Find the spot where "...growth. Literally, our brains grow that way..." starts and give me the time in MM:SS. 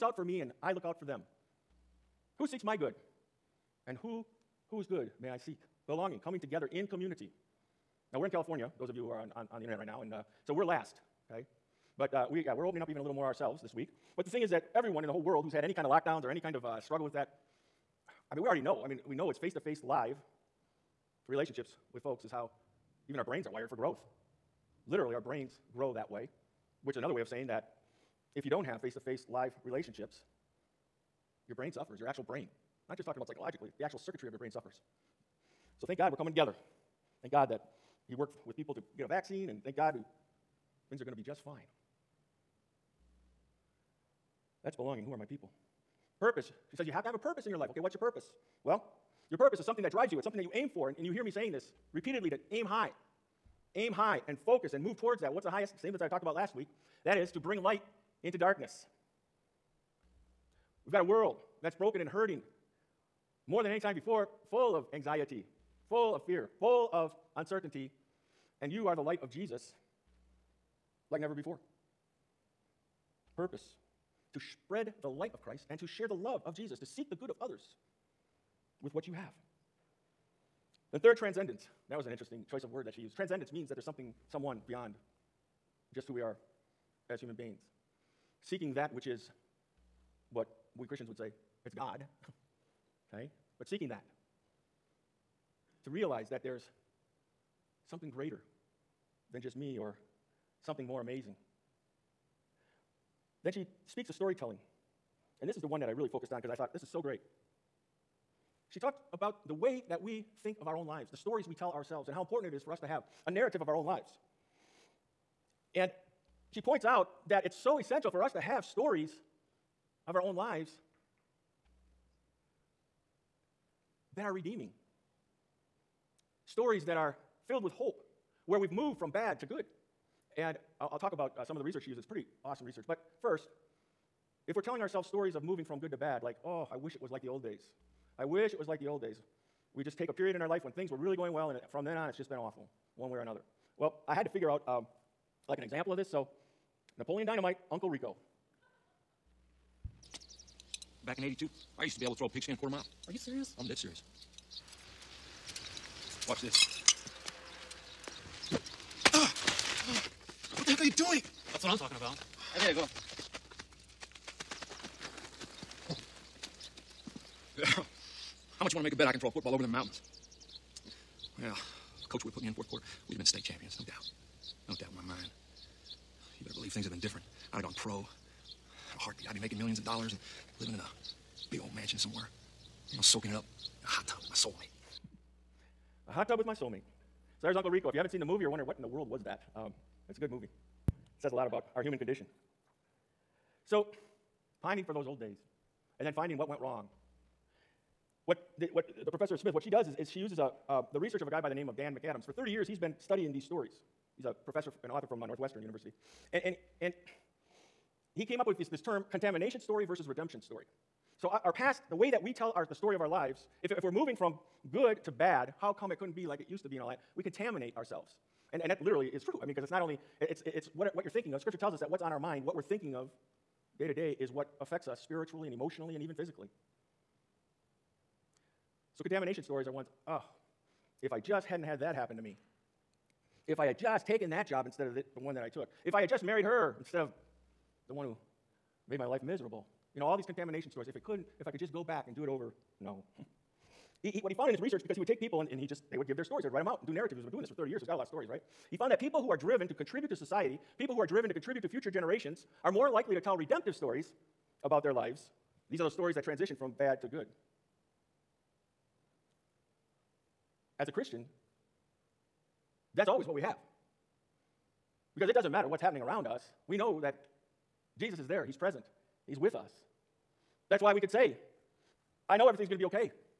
00:23.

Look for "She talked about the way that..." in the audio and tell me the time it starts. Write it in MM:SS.
01:48.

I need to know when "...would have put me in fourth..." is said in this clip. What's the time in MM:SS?
02:52.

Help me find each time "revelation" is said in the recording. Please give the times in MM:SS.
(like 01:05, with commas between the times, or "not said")
not said.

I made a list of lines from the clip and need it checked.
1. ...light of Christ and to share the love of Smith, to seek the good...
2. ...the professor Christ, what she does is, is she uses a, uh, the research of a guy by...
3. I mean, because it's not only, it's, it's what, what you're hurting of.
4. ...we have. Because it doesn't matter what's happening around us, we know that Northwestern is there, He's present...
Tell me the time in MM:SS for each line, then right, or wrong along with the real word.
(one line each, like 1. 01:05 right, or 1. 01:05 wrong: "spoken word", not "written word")
1. 01:15 wrong: "Jesus", not "Smith"
2. 03:19 wrong: "Smith", not "Christ"
3. 03:39 wrong: "thinking", not "hurting"
4. 04:23 wrong: "Jesus", not "Northwestern".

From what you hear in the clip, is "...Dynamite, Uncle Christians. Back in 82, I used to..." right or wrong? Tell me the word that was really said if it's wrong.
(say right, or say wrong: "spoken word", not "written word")
wrong: "Rico", not "Christians".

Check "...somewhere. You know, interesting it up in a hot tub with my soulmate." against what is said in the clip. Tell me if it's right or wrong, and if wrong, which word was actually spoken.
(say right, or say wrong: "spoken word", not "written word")
wrong: "soaking", not "interesting".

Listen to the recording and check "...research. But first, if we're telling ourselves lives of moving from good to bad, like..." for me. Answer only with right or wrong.
wrong.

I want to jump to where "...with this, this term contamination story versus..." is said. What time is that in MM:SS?
03:28.